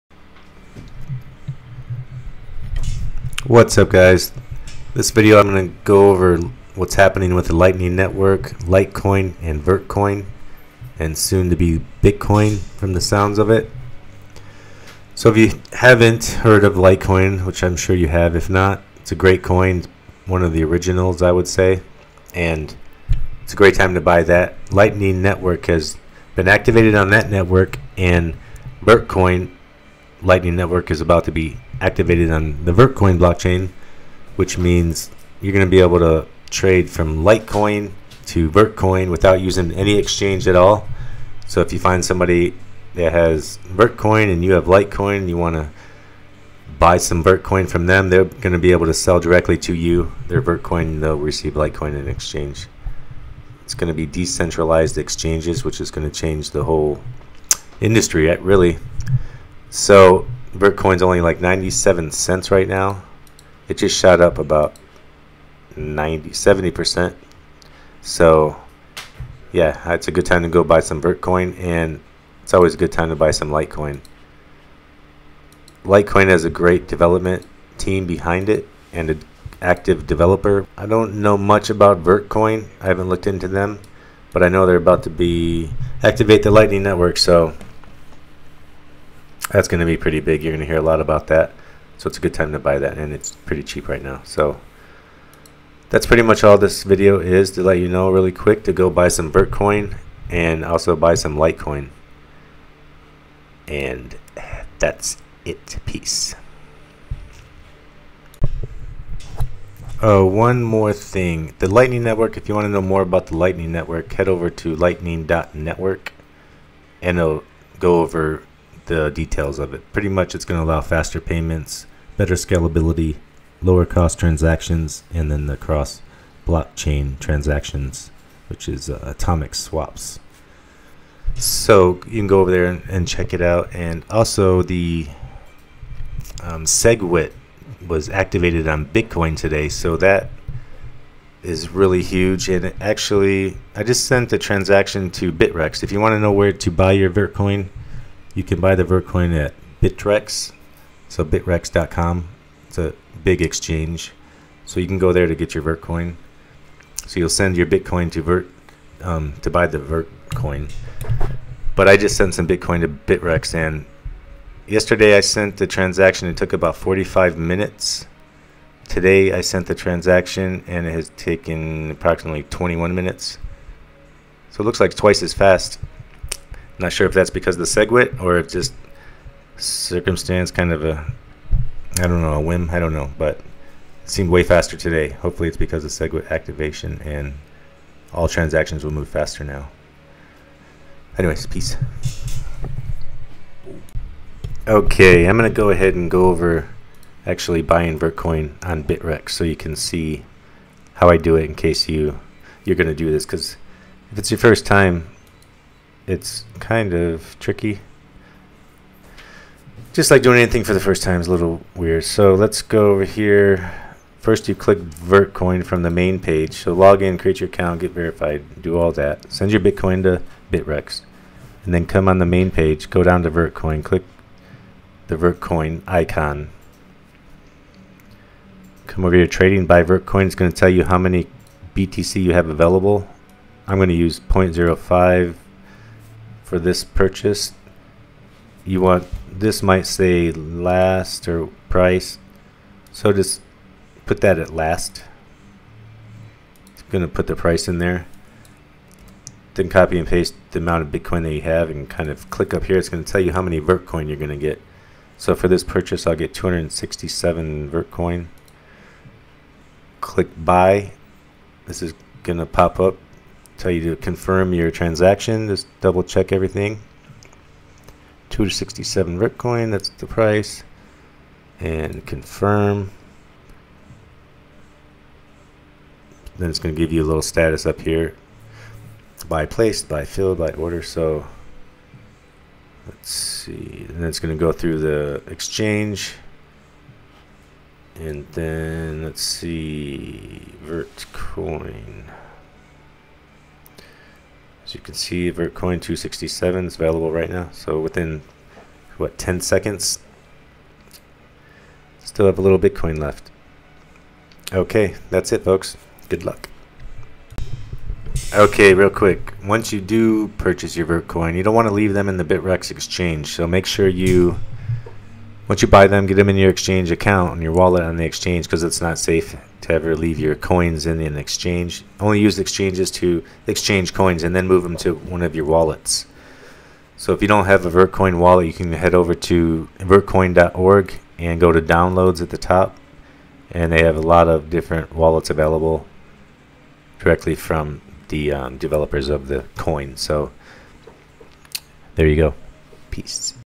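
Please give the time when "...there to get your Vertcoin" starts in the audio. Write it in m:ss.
2:35.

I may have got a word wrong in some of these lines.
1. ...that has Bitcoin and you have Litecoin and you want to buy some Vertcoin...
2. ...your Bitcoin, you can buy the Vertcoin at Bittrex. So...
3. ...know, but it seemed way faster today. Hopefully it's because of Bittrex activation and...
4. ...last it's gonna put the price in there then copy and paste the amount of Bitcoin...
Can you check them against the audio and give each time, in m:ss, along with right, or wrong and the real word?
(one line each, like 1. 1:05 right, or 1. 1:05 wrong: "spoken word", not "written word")
1. 0:42 wrong: "Vertcoin", not "Bitcoin"
2. 2:26 right
3. 3:02 wrong: "SegWit", not "Bittrex"
4. 4:04 right.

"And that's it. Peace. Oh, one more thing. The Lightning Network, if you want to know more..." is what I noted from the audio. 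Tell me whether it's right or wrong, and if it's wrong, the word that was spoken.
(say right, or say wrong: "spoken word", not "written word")
right.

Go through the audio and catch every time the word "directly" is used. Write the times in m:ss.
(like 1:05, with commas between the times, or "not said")
0:49, 5:36.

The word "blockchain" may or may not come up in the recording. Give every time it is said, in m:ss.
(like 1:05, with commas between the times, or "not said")
0:33, 2:06.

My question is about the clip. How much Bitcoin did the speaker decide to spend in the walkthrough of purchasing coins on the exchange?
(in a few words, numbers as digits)
0.05.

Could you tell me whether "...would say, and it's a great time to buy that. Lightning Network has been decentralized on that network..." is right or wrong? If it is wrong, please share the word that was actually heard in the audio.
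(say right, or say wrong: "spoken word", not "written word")
wrong: "activated", not "decentralized".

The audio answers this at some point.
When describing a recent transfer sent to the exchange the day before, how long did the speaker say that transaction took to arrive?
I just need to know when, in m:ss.
2:46.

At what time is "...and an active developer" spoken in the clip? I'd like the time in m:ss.
1:18.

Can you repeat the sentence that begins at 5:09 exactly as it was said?
Once you do purchase your Vertcoin, you don't want to leave them in the Bittrex exchange.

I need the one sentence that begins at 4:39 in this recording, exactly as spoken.
By placed, by filled, by order.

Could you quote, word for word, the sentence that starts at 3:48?
Come over here, trading by Vertcoin.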